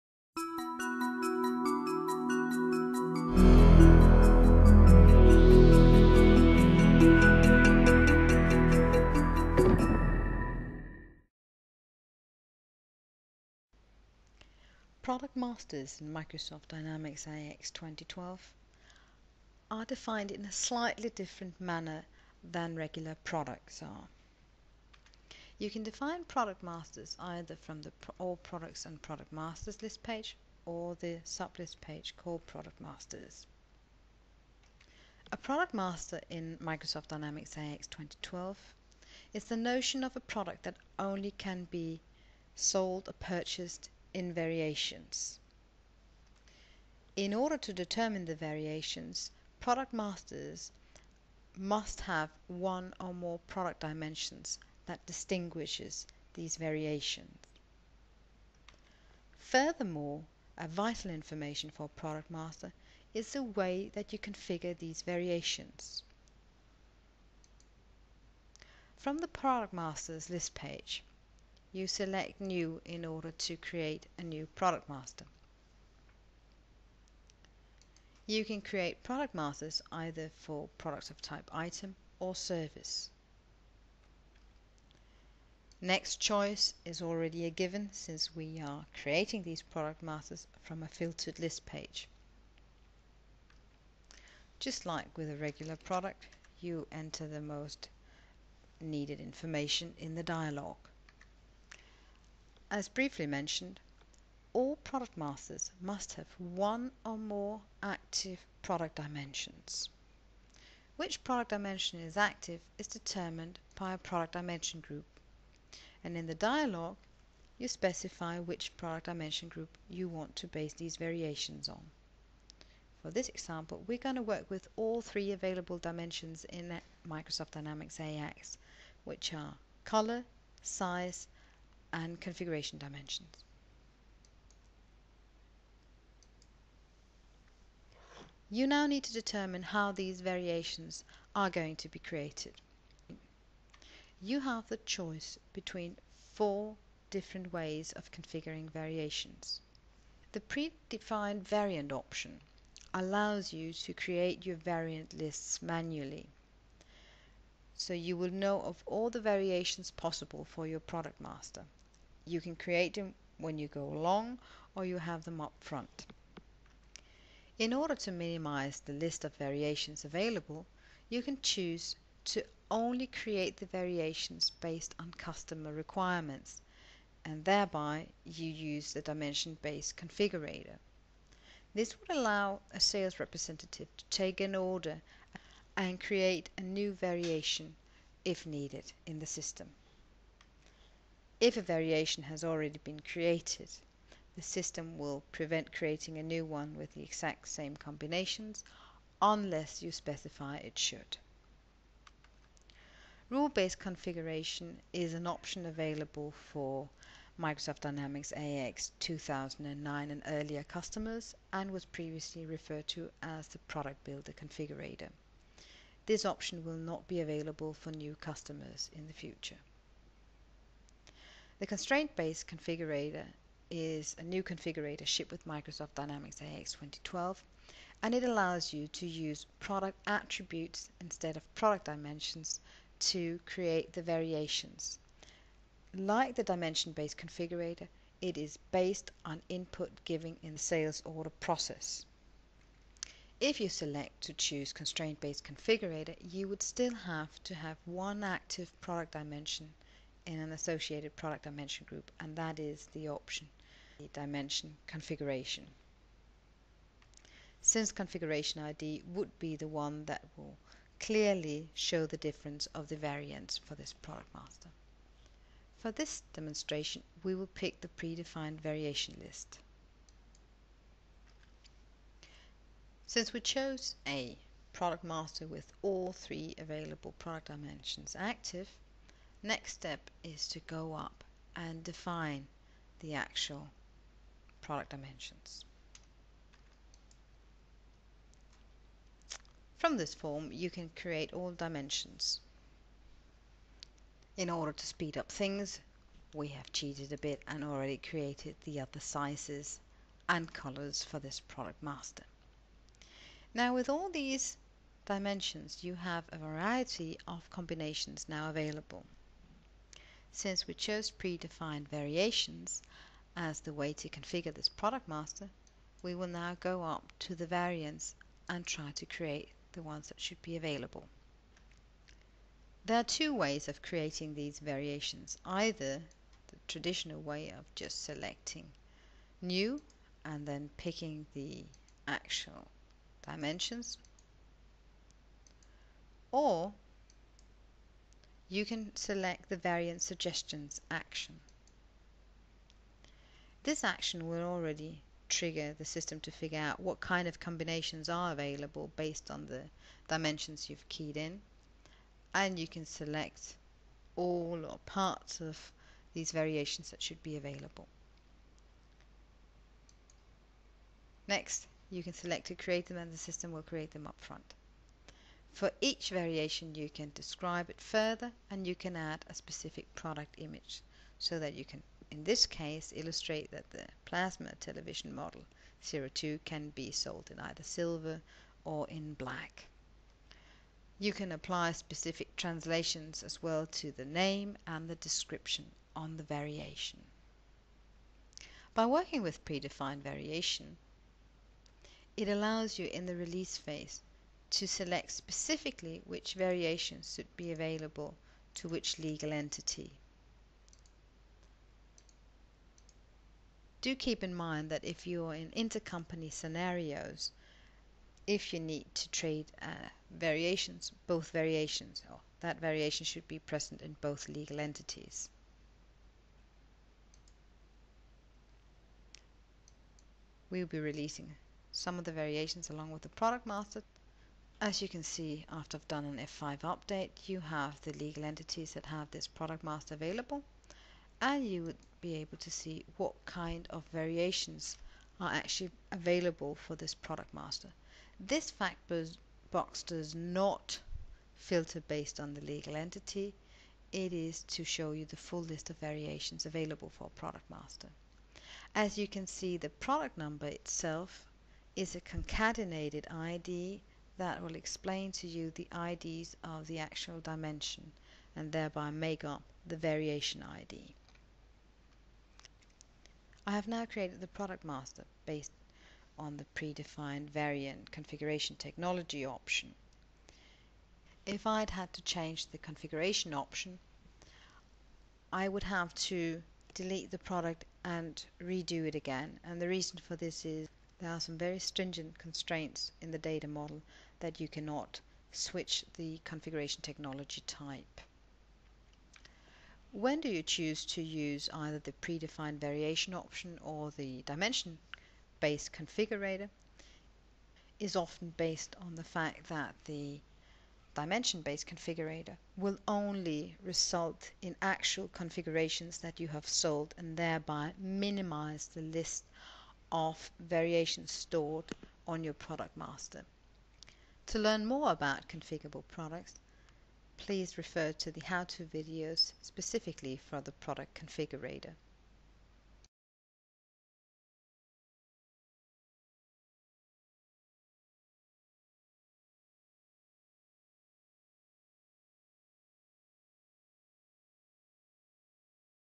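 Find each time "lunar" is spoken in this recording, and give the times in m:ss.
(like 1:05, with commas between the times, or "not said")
not said.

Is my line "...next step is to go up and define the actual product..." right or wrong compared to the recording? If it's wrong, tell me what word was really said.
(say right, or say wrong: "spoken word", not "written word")
right.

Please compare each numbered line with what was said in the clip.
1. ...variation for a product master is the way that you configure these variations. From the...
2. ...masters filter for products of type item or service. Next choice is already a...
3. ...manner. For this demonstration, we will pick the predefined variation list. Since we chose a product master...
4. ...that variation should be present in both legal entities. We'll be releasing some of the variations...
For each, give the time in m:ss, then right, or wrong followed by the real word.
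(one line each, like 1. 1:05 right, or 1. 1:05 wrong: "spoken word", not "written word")
1. 1:01 wrong: "information", not "variation"
2. 1:19 wrong: "either", not "filter"
3. 4:24 wrong: "master", not "manner"
4. 6:52 right.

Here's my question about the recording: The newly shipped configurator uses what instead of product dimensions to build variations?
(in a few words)
Product attributes.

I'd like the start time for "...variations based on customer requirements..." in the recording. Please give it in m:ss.
2:53.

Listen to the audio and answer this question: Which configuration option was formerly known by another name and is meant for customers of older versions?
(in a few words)
Rule-based configuration.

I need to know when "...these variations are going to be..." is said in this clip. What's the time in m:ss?
2:19.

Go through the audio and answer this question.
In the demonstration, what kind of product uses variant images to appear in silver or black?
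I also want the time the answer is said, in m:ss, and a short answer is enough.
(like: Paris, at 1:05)
Plasma television, at 6:14.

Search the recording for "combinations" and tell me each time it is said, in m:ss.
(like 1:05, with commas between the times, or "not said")
3:17, 5:07, 5:47.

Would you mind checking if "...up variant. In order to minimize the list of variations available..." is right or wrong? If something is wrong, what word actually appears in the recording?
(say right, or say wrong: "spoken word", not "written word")
wrong: "front", not "variant".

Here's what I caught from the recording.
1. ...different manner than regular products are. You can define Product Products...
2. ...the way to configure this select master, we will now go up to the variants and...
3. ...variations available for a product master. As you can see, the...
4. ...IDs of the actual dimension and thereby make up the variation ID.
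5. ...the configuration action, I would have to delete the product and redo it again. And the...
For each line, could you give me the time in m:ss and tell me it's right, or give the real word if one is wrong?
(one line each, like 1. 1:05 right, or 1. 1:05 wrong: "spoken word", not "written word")
1. 0:21 wrong: "Masters", not "Products"
2. 5:13 wrong: "product", not "select"
3. 7:25 right
4. 7:35 right
5. 7:52 wrong: "option", not "action".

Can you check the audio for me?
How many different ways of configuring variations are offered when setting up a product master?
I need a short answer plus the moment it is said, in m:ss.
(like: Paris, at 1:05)
4, at 2:26.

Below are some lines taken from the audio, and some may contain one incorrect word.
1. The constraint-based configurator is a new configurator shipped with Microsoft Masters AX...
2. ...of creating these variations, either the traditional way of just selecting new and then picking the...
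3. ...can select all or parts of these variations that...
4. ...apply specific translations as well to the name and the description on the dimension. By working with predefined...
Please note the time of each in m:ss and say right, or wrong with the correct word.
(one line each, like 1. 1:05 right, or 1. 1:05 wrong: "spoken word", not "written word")
1. 3:41 wrong: "Dynamics", not "Masters"
2. 5:23 right
3. 5:52 right
4. 6:21 wrong: "variation", not "dimension".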